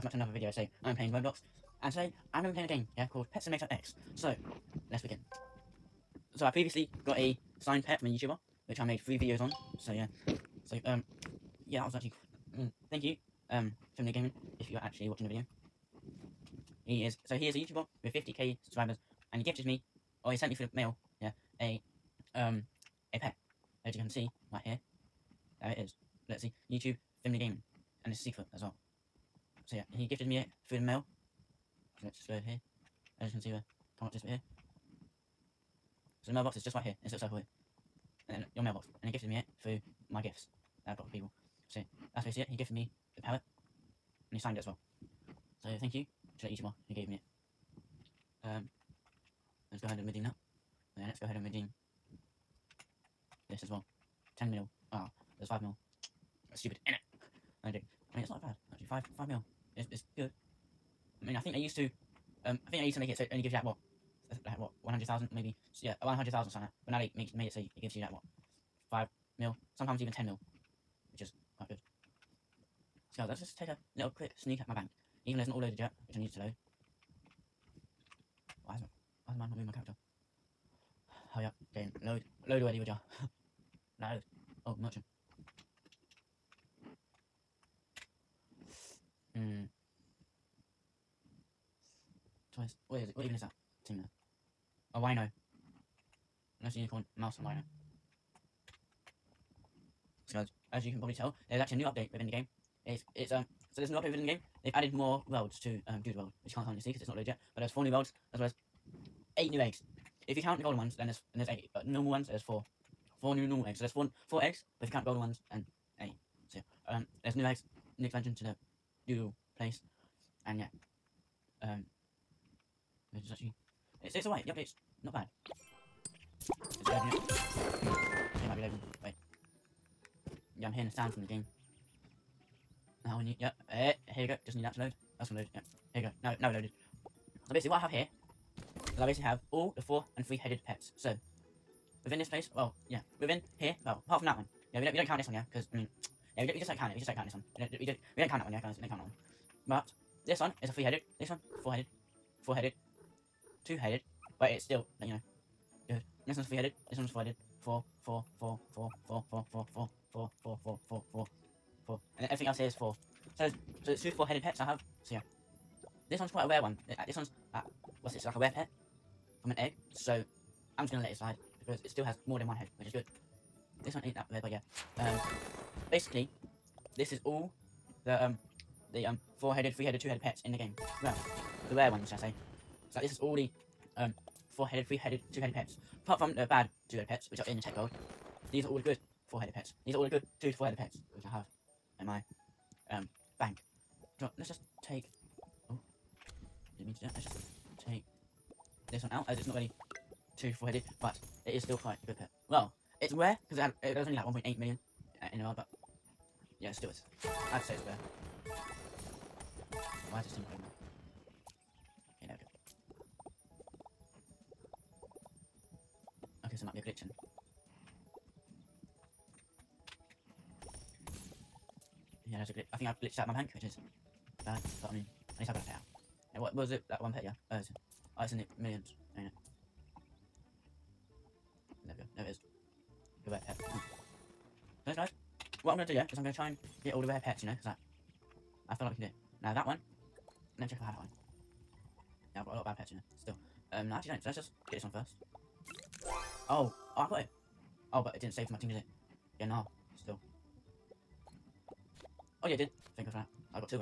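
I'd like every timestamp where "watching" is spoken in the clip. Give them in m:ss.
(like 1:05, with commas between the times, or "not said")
0:15.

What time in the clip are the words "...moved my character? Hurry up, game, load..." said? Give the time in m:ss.
1:19.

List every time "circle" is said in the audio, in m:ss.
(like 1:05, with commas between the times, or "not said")
0:37.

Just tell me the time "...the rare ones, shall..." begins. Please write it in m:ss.
3:01.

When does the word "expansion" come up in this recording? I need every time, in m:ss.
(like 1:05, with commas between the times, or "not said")
1:58.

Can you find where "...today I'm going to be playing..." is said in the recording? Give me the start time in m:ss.
0:01.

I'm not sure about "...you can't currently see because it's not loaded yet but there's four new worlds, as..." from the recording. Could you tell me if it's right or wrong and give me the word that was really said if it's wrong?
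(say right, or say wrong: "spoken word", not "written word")
right.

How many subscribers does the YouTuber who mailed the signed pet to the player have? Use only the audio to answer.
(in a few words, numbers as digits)
50k.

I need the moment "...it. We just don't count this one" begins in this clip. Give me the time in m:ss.
2:26.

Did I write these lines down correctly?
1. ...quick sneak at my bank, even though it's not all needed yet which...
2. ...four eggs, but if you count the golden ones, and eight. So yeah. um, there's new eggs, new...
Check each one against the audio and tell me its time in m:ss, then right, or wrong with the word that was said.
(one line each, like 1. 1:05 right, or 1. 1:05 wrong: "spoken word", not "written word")
1. 1:14 wrong: "loaded", not "needed"
2. 1:54 right.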